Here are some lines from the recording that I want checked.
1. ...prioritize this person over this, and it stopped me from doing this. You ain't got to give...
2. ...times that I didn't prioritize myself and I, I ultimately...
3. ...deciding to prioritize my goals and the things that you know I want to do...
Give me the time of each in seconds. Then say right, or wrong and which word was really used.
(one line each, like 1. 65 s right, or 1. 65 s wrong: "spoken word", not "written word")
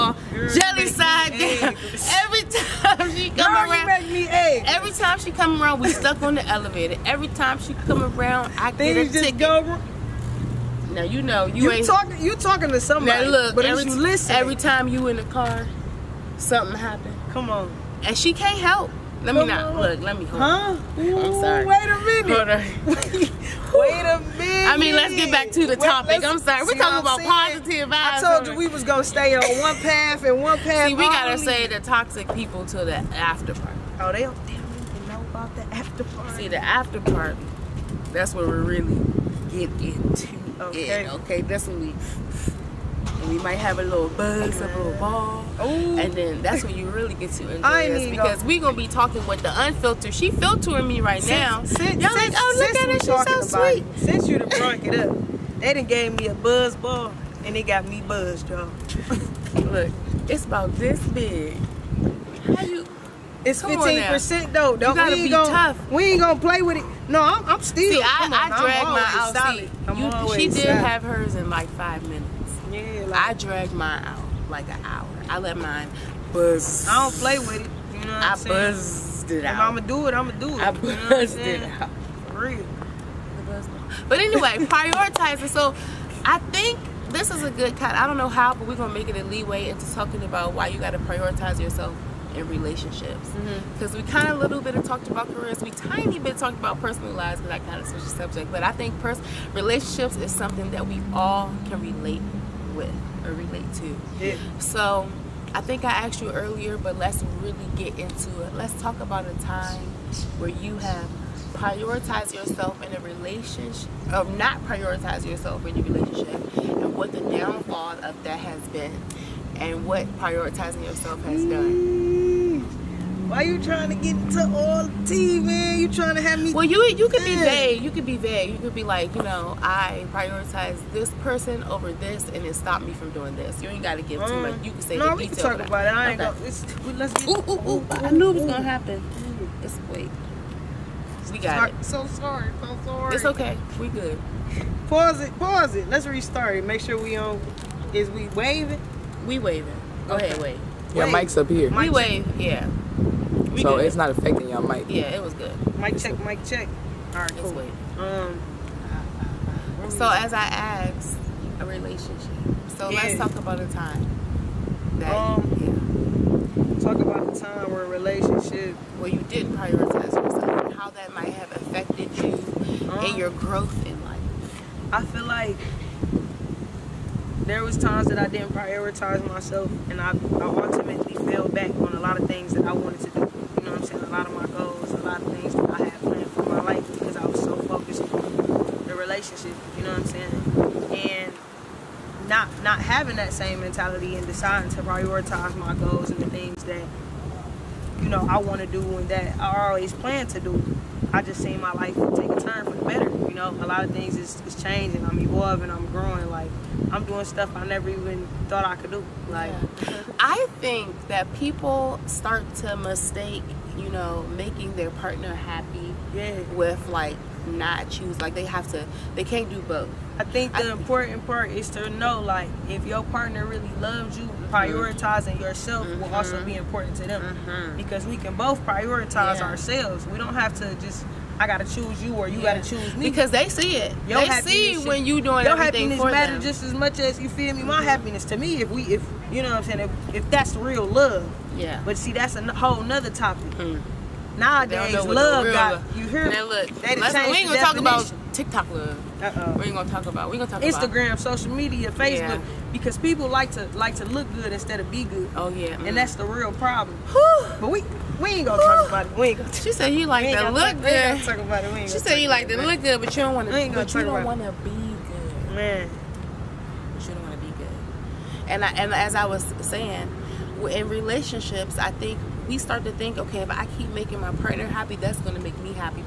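1. 130 s right
2. 177 s right
3. 194 s right.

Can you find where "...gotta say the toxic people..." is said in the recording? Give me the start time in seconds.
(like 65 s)
31 s.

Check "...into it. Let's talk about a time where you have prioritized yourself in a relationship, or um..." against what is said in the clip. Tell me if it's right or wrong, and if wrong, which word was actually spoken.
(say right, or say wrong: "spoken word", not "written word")
right.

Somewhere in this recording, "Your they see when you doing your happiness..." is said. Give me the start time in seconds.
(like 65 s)
234 s.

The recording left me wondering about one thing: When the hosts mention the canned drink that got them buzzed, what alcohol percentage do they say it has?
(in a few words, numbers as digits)
15%.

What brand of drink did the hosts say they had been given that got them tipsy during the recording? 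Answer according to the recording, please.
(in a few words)
Buzz Ball.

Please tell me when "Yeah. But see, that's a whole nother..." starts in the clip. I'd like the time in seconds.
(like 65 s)
241 s.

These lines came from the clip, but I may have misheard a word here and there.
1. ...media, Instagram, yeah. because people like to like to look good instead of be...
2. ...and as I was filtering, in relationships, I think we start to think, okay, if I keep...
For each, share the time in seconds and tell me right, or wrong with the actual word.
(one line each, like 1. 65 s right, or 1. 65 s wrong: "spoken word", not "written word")
1. 251 s wrong: "Facebook", not "Instagram"
2. 268 s wrong: "saying", not "filtering".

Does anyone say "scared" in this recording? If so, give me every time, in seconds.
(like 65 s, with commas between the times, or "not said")
not said.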